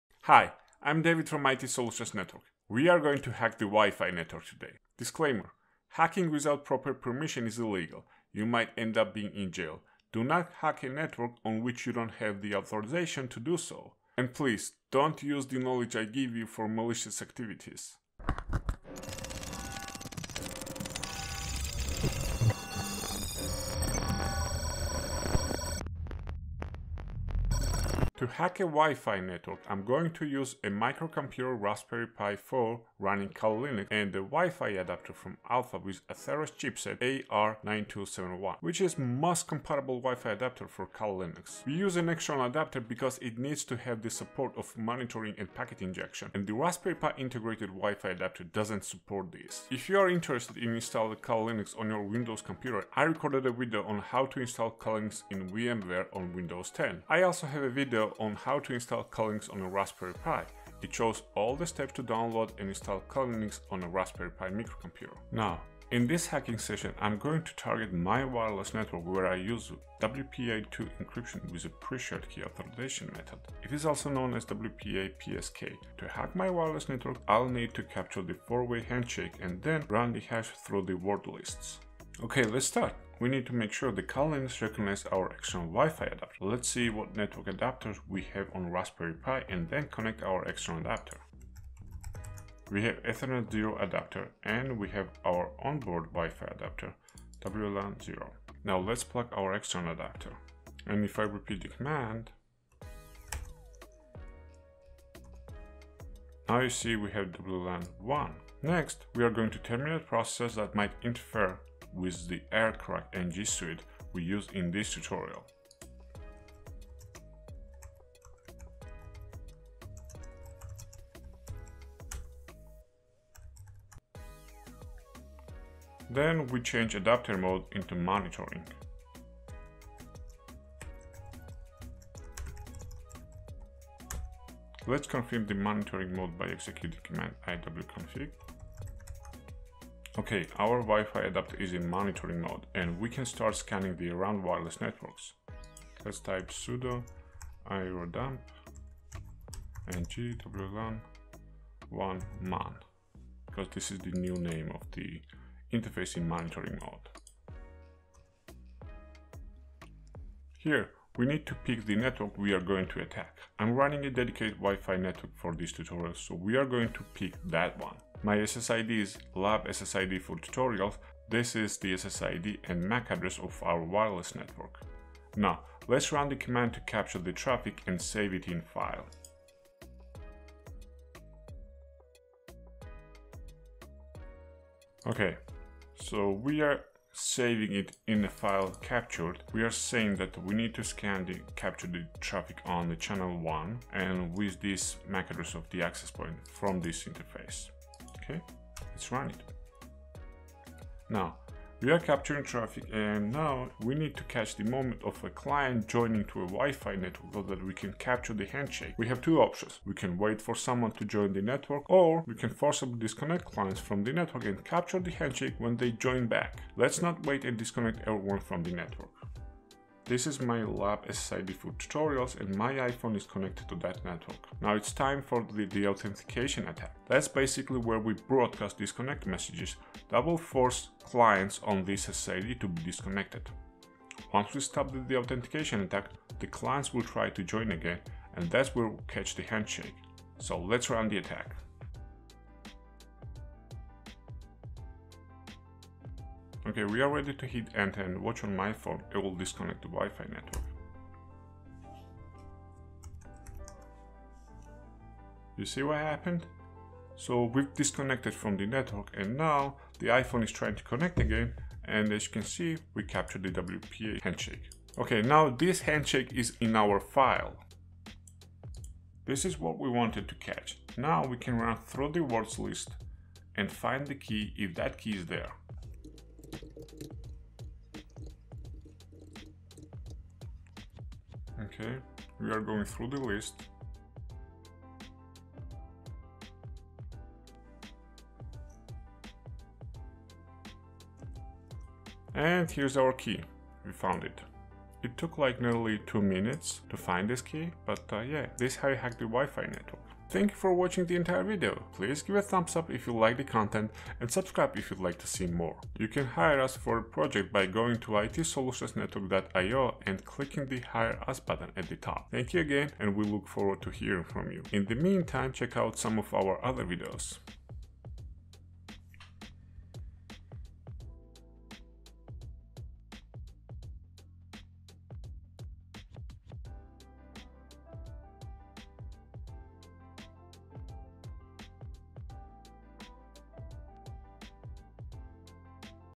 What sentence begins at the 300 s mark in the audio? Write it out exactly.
Thank you for watching the entire video.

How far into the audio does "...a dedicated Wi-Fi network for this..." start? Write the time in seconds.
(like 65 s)
164 s.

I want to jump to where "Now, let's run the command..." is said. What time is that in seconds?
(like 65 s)
175 s.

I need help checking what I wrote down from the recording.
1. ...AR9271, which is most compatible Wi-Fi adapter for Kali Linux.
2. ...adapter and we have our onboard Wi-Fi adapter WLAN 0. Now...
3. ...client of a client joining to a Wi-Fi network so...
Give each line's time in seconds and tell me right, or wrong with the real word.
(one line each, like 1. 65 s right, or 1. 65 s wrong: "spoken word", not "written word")
1. 37 s right
2. 93 s right
3. 204 s wrong: "moment", not "client".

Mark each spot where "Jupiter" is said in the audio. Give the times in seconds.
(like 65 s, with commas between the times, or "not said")
not said.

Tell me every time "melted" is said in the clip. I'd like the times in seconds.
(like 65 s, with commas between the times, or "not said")
not said.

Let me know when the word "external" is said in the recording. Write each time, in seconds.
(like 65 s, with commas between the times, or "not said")
42 s, 85 s, 90 s, 99 s.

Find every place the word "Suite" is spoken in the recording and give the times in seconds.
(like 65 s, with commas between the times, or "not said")
113 s.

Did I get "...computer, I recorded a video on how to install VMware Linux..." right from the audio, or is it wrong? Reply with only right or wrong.
wrong.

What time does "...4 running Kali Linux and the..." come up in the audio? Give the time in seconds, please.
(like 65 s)
32 s.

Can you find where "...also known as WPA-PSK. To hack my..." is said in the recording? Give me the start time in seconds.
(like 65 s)
73 s.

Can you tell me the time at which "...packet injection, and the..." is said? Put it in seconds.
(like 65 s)
45 s.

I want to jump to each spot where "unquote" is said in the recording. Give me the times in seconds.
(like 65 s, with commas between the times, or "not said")
not said.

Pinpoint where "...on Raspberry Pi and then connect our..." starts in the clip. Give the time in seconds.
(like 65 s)
88 s.